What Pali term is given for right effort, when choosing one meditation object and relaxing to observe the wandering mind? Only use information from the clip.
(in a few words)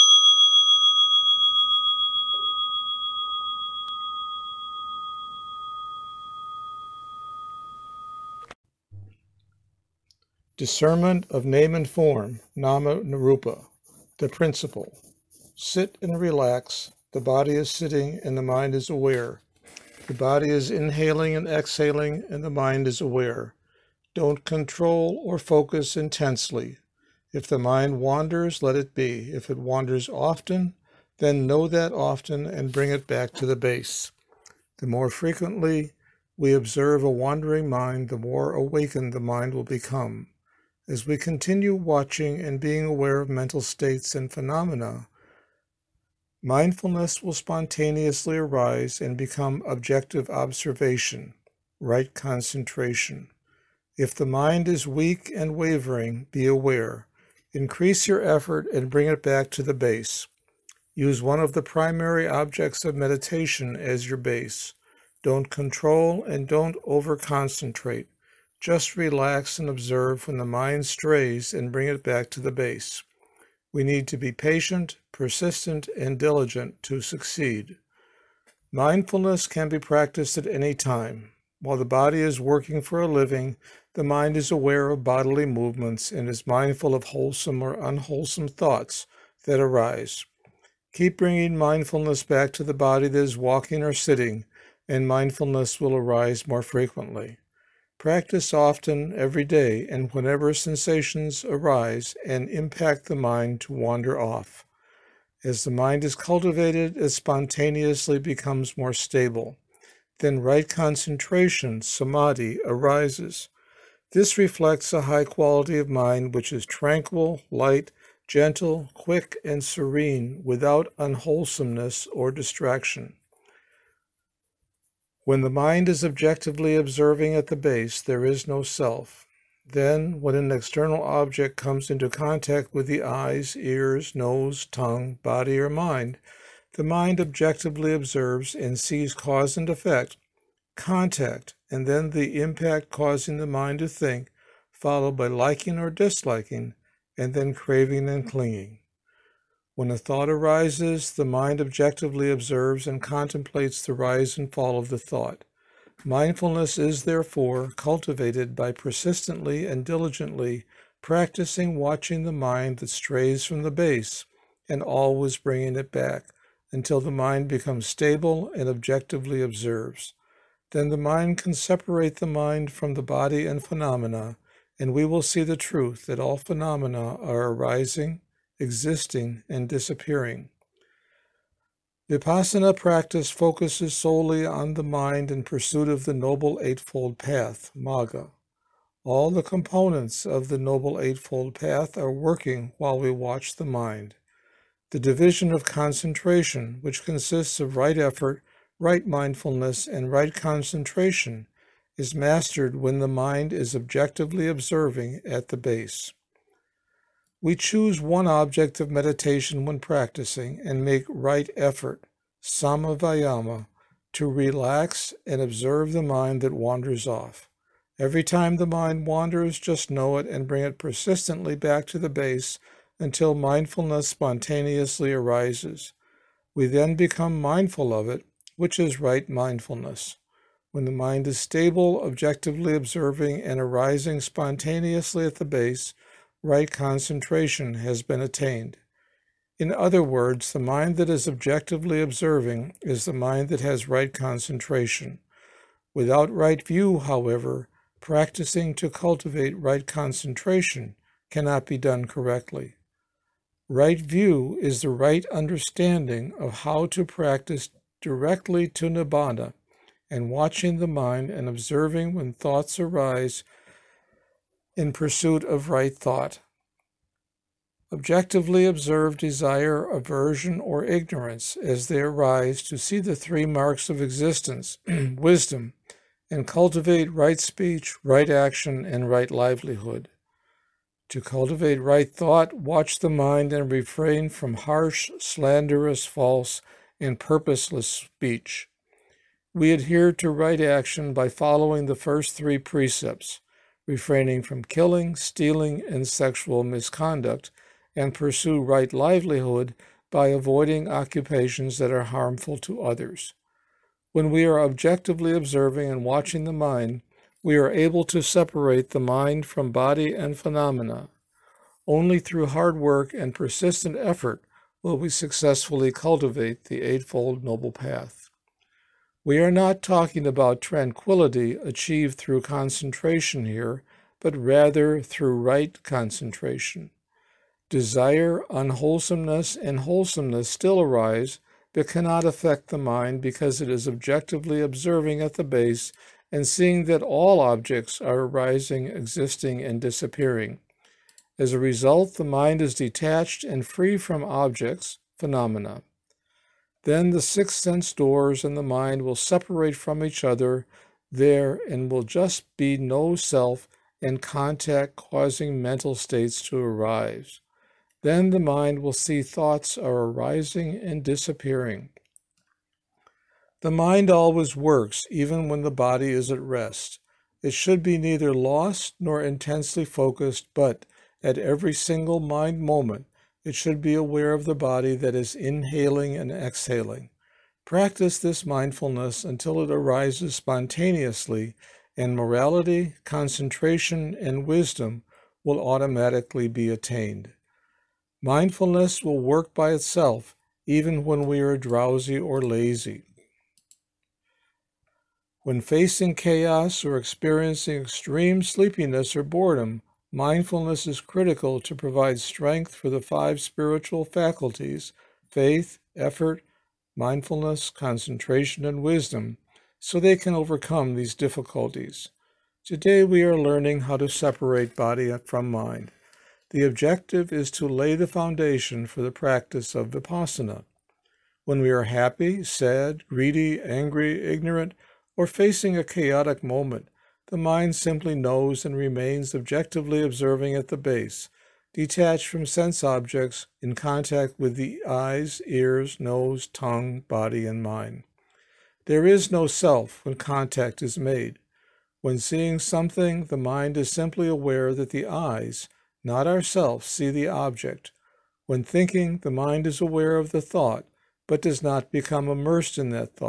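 sammavayama.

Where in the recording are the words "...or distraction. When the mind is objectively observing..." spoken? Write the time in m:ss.
2:02.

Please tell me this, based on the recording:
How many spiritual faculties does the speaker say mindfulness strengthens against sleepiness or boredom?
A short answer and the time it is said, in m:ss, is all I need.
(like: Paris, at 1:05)
5, at 6:43.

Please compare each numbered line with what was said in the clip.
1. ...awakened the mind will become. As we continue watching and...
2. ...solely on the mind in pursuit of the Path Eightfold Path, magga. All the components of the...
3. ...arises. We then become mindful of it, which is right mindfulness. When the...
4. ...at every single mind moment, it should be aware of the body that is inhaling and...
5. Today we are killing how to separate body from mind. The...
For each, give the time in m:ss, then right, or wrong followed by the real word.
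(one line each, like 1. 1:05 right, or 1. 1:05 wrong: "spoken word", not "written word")
1. 0:38 right
2. 3:03 wrong: "Noble", not "Path"
3. 3:45 right
4. 6:11 right
5. 6:52 wrong: "learning", not "killing".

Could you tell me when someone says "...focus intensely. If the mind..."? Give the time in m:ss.
0:25.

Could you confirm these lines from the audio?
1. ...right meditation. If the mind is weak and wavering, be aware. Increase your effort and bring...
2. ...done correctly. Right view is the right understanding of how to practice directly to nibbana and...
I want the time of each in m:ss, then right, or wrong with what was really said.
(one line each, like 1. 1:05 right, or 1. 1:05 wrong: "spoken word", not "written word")
1. 0:51 wrong: "concentration", not "meditation"
2. 4:11 right.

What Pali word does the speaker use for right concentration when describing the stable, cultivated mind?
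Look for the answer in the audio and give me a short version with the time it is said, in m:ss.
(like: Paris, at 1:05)
samadhi, at 1:51.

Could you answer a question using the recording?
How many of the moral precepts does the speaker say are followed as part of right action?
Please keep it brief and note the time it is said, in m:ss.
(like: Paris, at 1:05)
3, at 4:51.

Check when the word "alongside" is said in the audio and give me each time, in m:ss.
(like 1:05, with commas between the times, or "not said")
not said.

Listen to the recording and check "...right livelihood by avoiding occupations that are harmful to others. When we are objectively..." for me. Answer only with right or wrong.
right.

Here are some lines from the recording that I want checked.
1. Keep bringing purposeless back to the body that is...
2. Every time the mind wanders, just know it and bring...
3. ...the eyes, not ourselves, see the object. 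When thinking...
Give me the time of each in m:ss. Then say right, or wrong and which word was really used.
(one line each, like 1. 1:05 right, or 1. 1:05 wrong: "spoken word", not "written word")
1. 1:30 wrong: "mindfulness", not "purposeless"
2. 3:37 right
3. 7:24 right.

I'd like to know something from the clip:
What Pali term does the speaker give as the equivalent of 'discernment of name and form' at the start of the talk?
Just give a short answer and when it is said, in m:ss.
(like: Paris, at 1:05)
nama narupa, at 0:12.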